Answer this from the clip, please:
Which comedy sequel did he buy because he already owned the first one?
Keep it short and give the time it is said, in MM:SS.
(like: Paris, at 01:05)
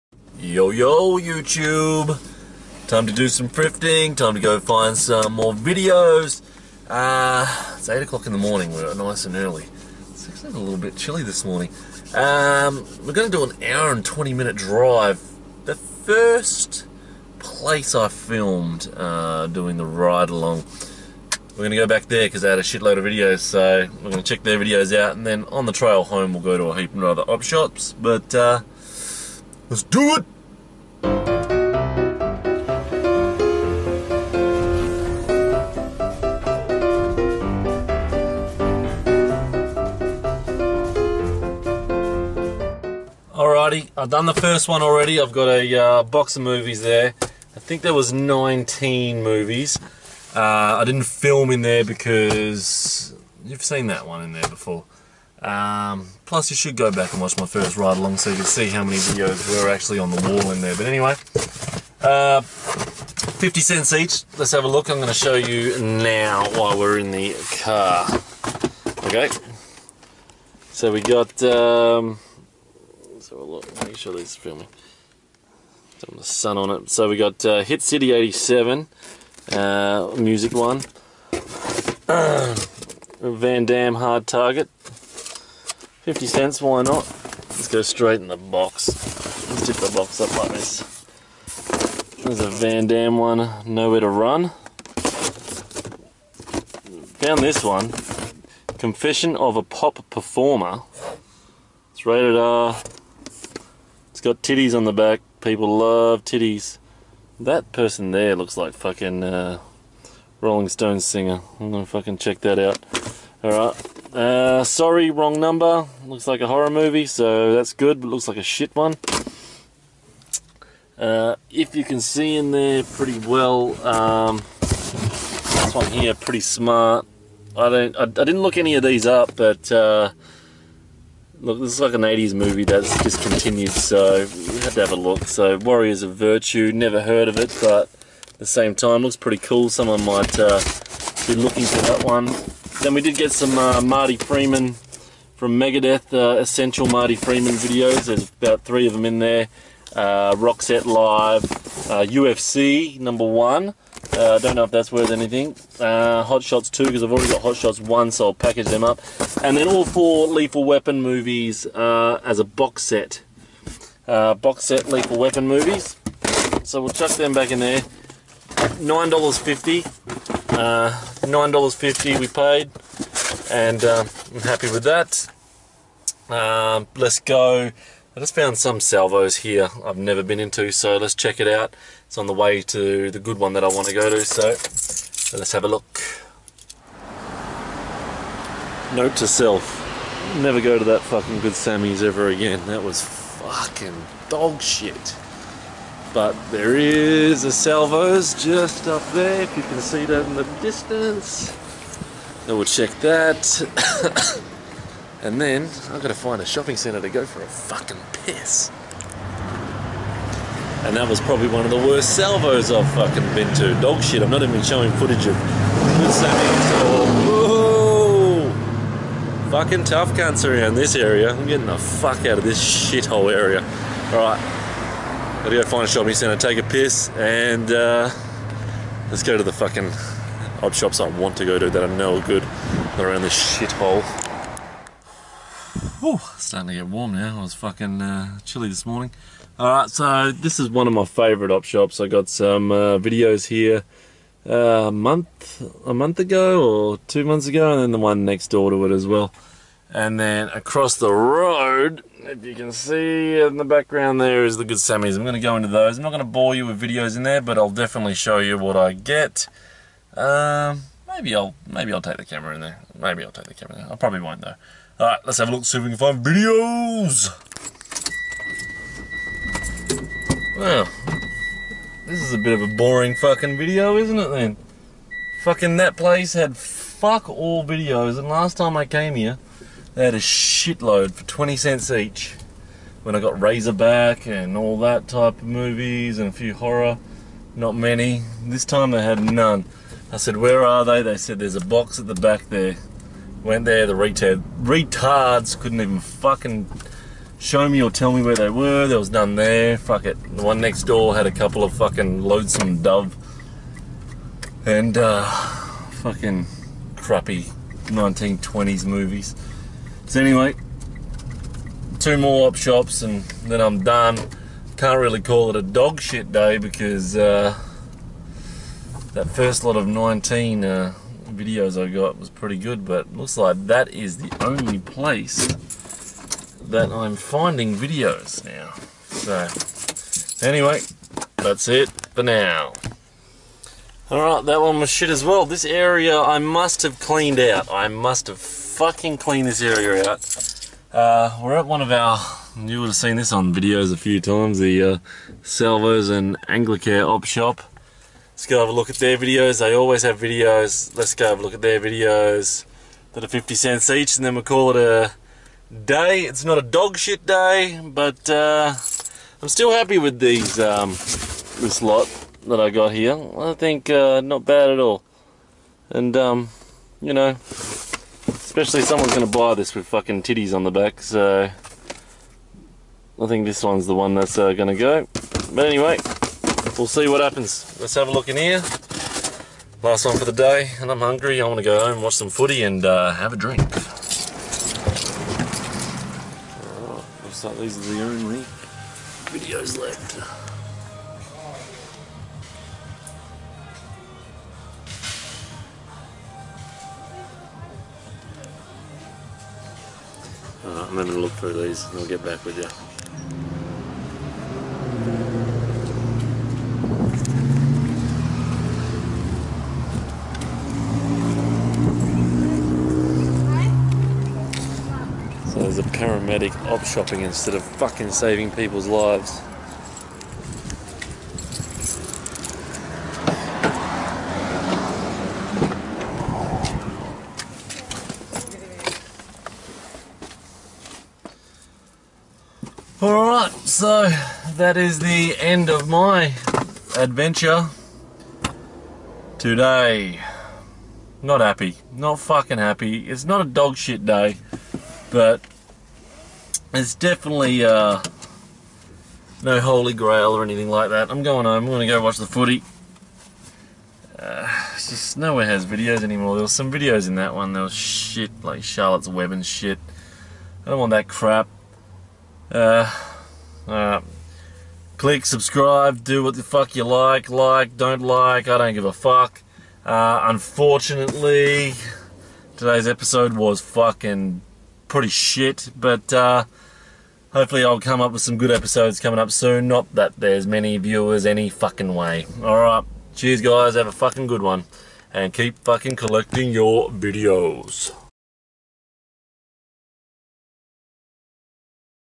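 Hot Shots 2, at 02:36.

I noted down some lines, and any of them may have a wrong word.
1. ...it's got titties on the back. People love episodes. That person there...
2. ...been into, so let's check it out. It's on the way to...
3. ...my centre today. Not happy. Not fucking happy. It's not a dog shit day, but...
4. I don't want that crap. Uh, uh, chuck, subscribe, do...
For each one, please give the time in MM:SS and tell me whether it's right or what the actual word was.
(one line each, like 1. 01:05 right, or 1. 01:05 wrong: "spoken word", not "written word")
1. 01:44 wrong: "titties", not "episodes"
2. 03:00 right
3. 07:15 wrong: "adventure", not "centre"
4. 07:40 wrong: "click", not "chuck".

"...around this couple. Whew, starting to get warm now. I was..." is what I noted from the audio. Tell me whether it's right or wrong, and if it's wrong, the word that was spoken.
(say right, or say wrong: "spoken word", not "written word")
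wrong: "shithole", not "couple".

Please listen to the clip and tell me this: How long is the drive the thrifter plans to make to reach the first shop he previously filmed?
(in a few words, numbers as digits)
1 hour 20 minutes.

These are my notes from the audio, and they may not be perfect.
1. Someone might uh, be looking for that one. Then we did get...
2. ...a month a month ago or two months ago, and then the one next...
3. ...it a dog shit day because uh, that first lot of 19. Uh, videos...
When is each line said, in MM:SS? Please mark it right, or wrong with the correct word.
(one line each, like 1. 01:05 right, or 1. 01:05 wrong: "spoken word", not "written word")
1. 02:19 right
2. 04:04 right
3. 05:15 right.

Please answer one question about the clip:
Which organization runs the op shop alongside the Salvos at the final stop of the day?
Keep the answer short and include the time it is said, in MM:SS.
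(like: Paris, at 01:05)
Anglicare, at 05:46.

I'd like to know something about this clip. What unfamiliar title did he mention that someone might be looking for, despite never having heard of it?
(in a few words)
Warriors of Virtue.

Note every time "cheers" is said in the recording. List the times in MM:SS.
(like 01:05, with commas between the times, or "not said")
08:03.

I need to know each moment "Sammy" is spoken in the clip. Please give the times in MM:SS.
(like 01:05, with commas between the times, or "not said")
03:11, 04:14.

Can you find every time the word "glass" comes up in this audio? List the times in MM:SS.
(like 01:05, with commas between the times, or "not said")
not said.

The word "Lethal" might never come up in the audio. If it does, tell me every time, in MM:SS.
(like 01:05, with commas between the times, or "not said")
02:40, 02:44.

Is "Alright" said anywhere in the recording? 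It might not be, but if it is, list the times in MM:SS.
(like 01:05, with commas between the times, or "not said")
01:53, 03:59, 04:25, 05:34, 07:13, 08:02.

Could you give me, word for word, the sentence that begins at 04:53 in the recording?
Went there, the retard, retards couldn't even fucking show me or tell me where they were.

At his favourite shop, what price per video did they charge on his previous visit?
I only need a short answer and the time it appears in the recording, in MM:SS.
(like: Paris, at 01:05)
20 cents, at 04:41.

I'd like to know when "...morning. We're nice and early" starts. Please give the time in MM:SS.
00:08.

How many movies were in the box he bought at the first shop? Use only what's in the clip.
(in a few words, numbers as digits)
19.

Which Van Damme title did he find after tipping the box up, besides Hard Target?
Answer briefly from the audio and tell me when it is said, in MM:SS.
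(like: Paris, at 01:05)
Nowhere to Run, at 01:33.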